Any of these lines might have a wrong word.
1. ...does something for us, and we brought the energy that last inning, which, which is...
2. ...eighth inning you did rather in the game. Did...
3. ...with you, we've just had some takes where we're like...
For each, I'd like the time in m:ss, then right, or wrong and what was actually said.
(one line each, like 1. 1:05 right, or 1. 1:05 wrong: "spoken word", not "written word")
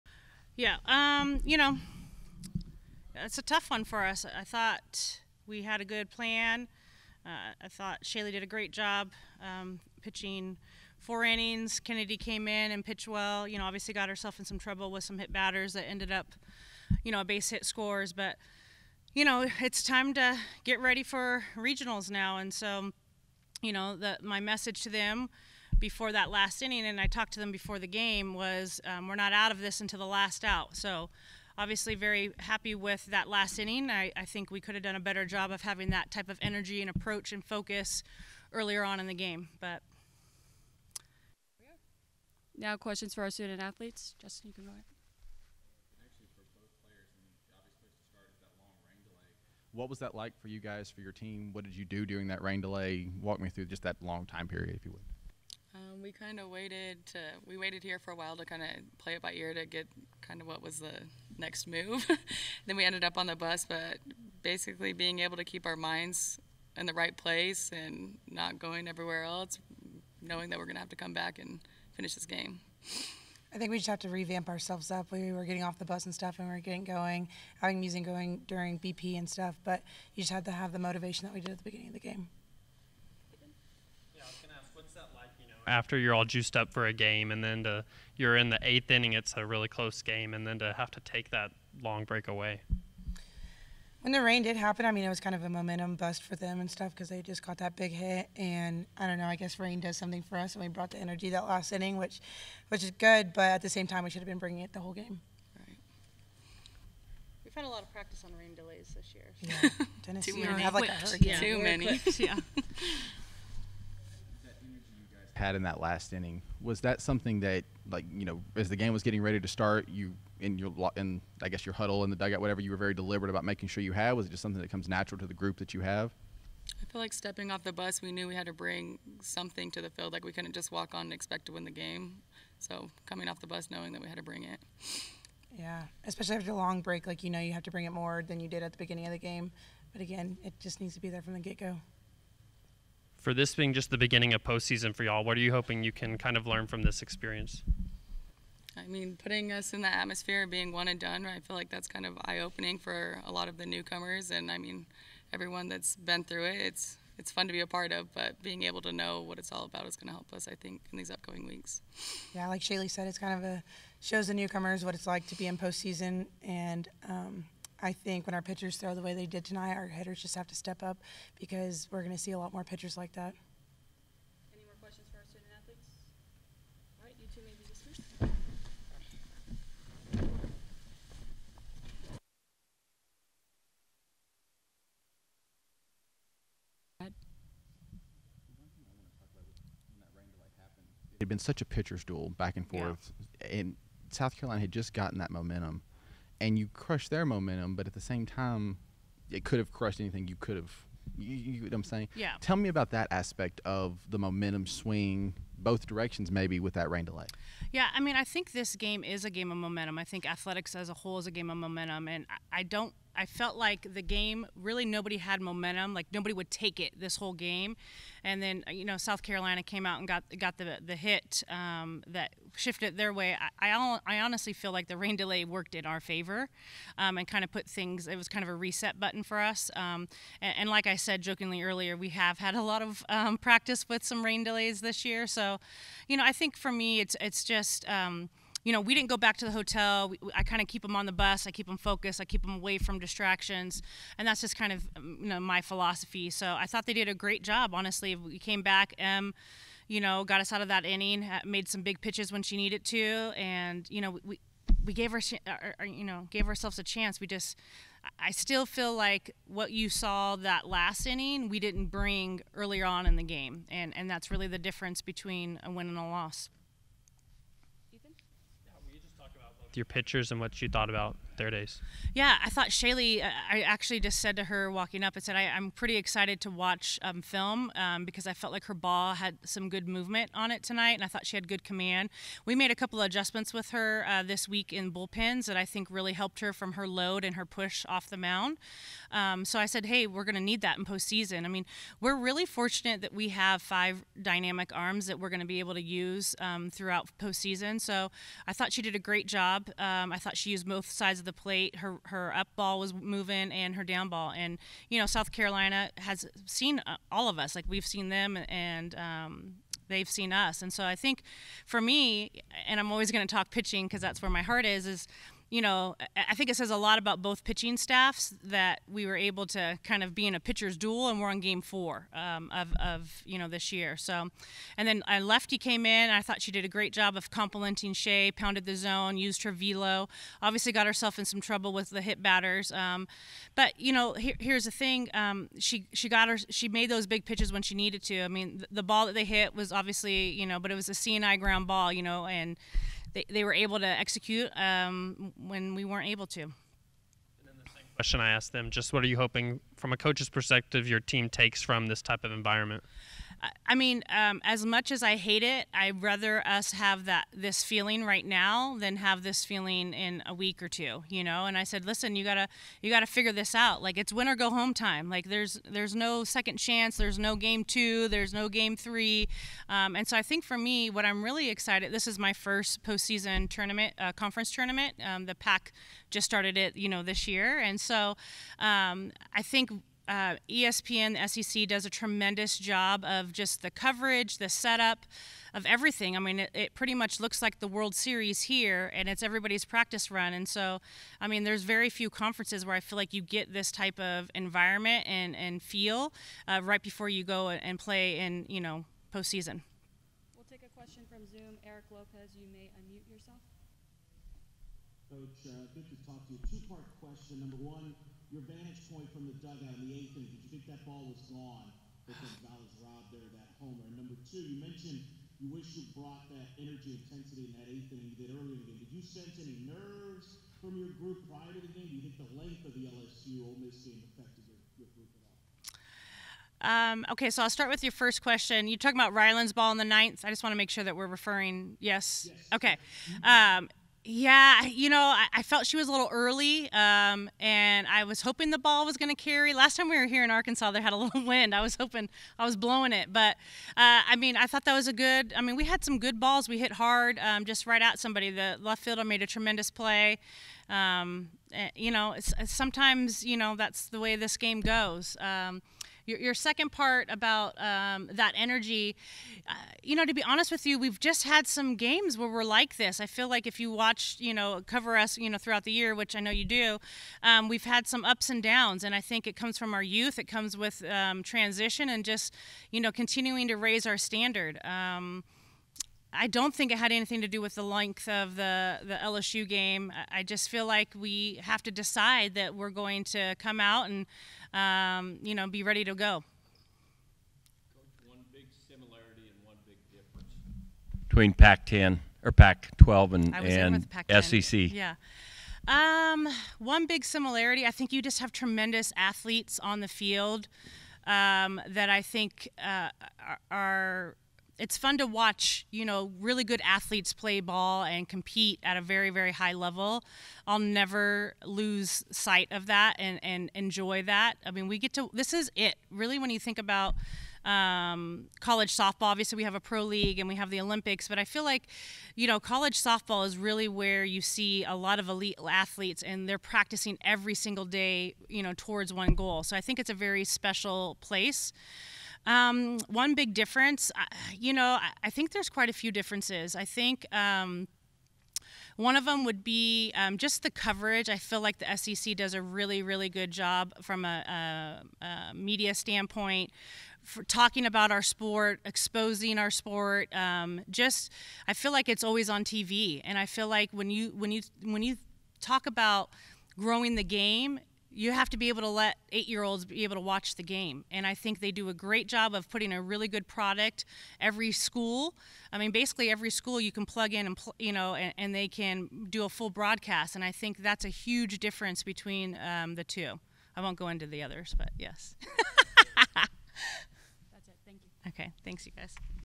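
1. 1:39 right
2. 6:57 wrong: "earlier", not "rather"
3. 7:40 wrong: "games", not "takes".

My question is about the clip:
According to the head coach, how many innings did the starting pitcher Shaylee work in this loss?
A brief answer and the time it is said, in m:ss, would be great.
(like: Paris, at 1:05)
4, at 0:10.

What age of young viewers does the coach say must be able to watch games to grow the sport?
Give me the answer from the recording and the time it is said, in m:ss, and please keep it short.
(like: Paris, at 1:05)
8, at 9:19.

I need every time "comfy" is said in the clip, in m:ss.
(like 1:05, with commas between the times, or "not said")
not said.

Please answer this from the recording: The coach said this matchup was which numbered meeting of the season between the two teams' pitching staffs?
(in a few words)
Game 4.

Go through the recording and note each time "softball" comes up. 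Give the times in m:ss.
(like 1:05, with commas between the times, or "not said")
8:38, 8:42.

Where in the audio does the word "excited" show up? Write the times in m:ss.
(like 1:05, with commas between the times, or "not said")
4:35, 6:11.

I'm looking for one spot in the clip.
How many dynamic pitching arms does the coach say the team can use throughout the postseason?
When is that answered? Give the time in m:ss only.
4:53.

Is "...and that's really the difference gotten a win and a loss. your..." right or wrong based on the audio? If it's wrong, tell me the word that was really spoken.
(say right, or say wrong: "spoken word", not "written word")
wrong: "between", not "gotten".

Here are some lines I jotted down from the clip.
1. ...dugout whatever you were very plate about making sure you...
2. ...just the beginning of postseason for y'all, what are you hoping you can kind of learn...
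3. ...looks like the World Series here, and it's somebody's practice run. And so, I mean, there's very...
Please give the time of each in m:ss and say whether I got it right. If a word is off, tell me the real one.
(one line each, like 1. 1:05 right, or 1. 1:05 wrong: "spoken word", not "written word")
1. 2:02 wrong: "deliberate", not "plate"
2. 2:23 right
3. 6:27 wrong: "everybody", not "somebody".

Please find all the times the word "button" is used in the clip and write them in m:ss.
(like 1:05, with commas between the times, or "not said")
3:48.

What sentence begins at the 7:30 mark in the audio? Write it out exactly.
Um, eh, you know, it's, sometimes you know that's the way this game goes.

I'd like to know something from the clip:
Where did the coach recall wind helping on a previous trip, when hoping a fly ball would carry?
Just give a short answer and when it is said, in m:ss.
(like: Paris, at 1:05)
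Arkansas, at 7:20.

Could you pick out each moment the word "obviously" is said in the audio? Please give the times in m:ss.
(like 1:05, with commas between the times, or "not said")
0:13, 0:31, 5:30, 5:39, 8:39.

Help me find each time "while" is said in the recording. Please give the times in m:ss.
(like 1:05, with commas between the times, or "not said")
0:58.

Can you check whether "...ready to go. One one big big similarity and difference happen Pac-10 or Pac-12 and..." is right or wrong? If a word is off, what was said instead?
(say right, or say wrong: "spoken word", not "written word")
wrong: "between", not "happen".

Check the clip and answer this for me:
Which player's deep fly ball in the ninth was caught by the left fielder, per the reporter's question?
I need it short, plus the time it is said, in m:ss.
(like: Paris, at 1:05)
Rylen, at 7:09.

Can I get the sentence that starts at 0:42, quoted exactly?
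Now questions for our student athletes.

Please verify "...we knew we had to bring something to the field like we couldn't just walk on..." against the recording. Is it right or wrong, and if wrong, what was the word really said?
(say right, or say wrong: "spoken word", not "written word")
right.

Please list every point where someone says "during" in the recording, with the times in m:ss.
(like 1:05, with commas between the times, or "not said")
0:52, 1:18.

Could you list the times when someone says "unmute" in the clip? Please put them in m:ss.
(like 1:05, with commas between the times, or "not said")
6:42.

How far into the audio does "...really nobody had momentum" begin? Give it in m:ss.
3:34.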